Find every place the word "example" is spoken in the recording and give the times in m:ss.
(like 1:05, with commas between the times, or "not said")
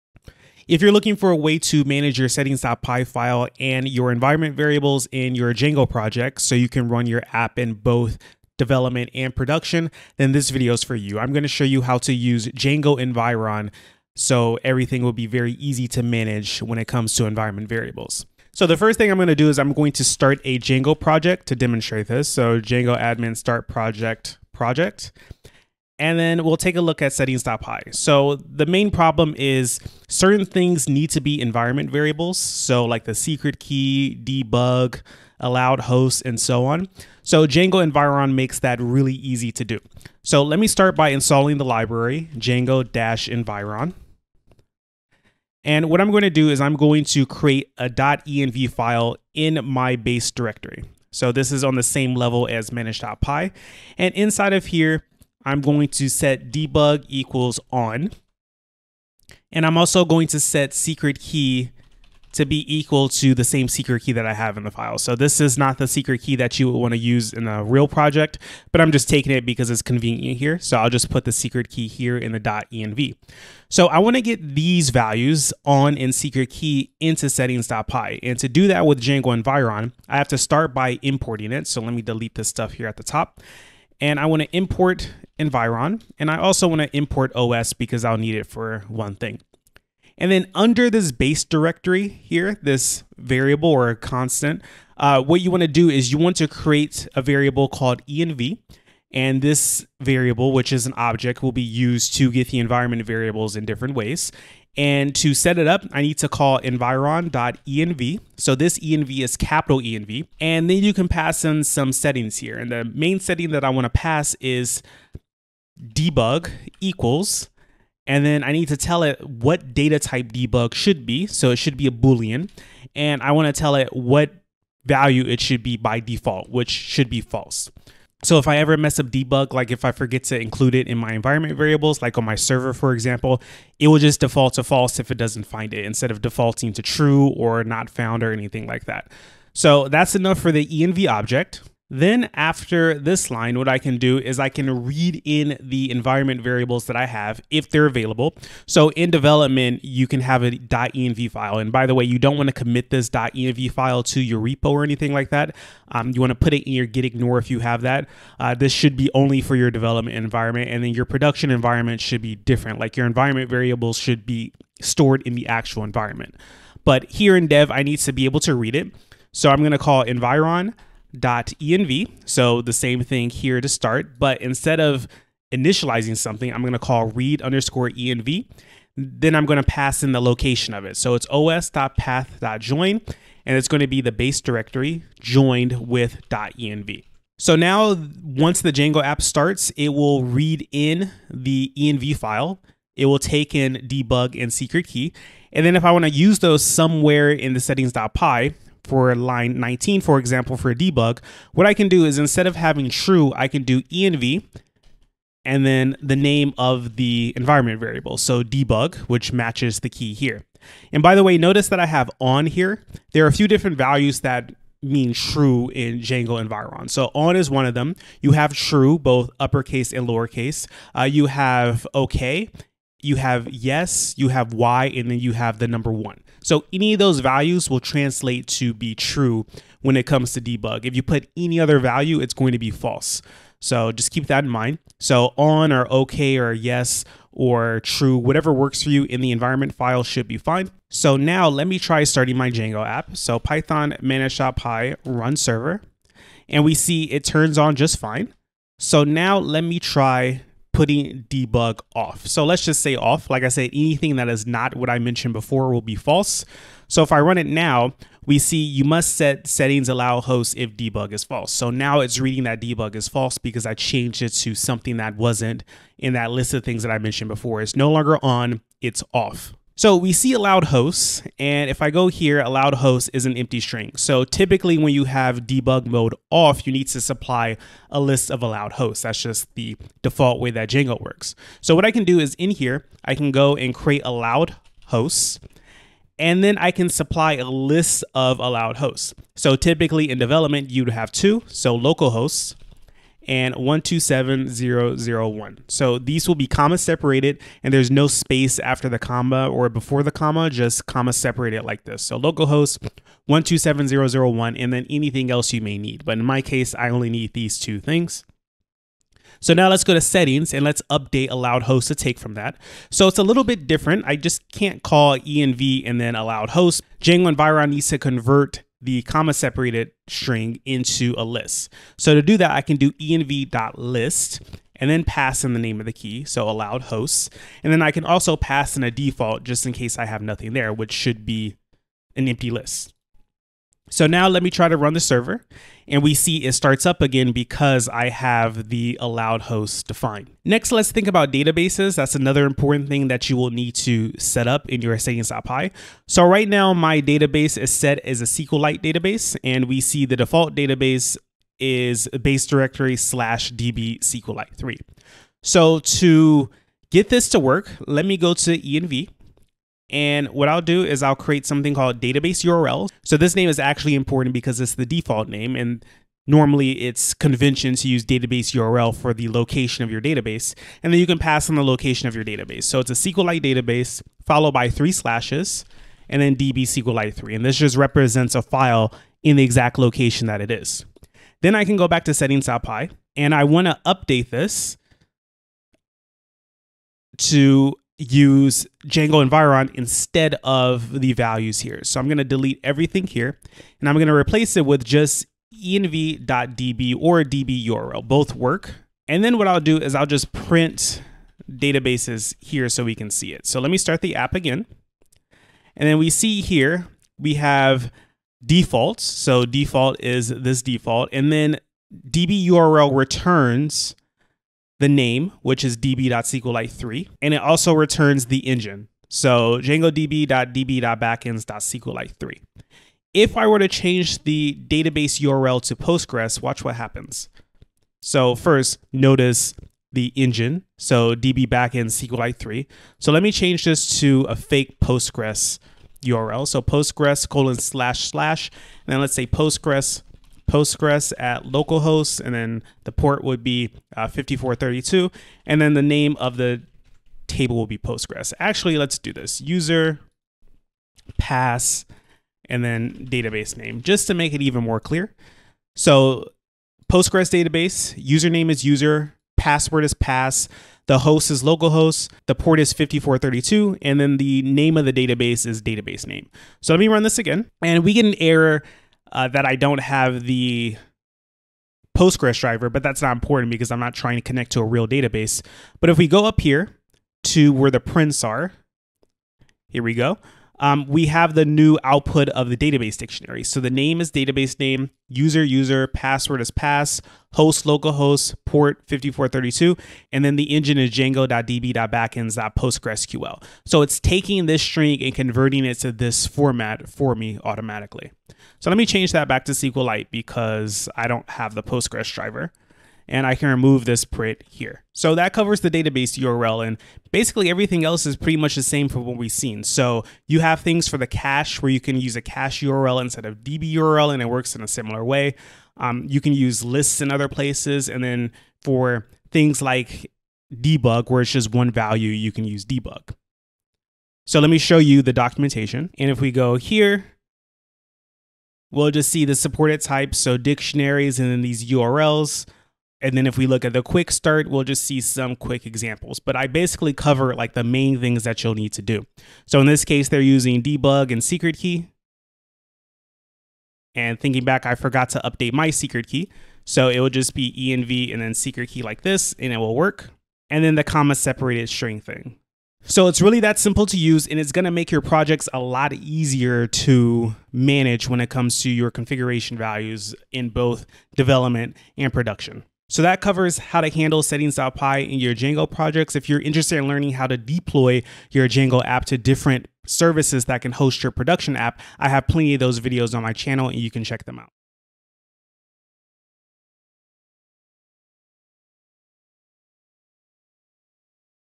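2:12, 3:20, 8:55.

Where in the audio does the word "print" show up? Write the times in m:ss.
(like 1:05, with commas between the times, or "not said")
6:40, 7:57, 8:24.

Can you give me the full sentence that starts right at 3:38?
You have true, both uppercase and lowercase.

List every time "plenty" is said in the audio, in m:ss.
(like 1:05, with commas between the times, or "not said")
9:32.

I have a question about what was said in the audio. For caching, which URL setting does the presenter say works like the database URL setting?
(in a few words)
cache URL.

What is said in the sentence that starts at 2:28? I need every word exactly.
So in development, you can have a .env file.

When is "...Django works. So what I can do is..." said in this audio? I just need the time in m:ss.
4:40.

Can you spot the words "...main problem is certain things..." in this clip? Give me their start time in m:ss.
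0:28.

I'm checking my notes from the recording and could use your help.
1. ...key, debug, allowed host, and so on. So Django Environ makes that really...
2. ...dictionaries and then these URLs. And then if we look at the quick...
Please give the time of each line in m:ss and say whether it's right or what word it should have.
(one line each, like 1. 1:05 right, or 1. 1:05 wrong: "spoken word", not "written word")
1. 0:33 right
2. 8:50 right.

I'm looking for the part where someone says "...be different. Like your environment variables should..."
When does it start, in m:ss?
2:42.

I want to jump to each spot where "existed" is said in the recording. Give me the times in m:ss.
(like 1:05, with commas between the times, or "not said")
not said.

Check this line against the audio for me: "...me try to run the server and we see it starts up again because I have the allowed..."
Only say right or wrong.
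right.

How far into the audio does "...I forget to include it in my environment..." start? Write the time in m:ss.
2:09.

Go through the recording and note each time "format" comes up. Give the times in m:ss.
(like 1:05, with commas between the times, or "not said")
8:16.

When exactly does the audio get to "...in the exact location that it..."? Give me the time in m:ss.
6:19.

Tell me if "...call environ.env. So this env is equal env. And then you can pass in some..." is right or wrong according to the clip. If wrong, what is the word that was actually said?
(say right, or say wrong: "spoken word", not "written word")
wrong: "capital", not "equal".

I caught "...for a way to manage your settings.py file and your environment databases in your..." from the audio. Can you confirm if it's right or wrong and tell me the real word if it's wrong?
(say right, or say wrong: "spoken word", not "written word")
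wrong: "variables", not "databases".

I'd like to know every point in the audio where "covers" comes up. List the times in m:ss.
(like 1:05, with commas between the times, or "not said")
8:25, 8:56, 9:23.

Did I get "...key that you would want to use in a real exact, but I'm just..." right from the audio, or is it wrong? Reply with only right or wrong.
wrong.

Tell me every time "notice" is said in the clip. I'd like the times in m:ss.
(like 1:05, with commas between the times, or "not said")
3:31, 7:08.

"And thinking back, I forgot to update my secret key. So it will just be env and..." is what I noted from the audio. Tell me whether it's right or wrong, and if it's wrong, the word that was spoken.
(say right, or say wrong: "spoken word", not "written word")
right.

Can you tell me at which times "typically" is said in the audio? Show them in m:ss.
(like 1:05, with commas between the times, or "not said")
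4:34, 4:49.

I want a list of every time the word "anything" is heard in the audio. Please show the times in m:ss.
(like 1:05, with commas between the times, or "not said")
2:18, 2:34, 4:13, 5:04.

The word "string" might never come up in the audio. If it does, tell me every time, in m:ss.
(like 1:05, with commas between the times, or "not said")
4:33, 5:20, 8:14, 9:11.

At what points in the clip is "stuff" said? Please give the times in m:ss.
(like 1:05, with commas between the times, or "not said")
1:22.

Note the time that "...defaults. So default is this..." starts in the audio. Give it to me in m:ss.
6:48.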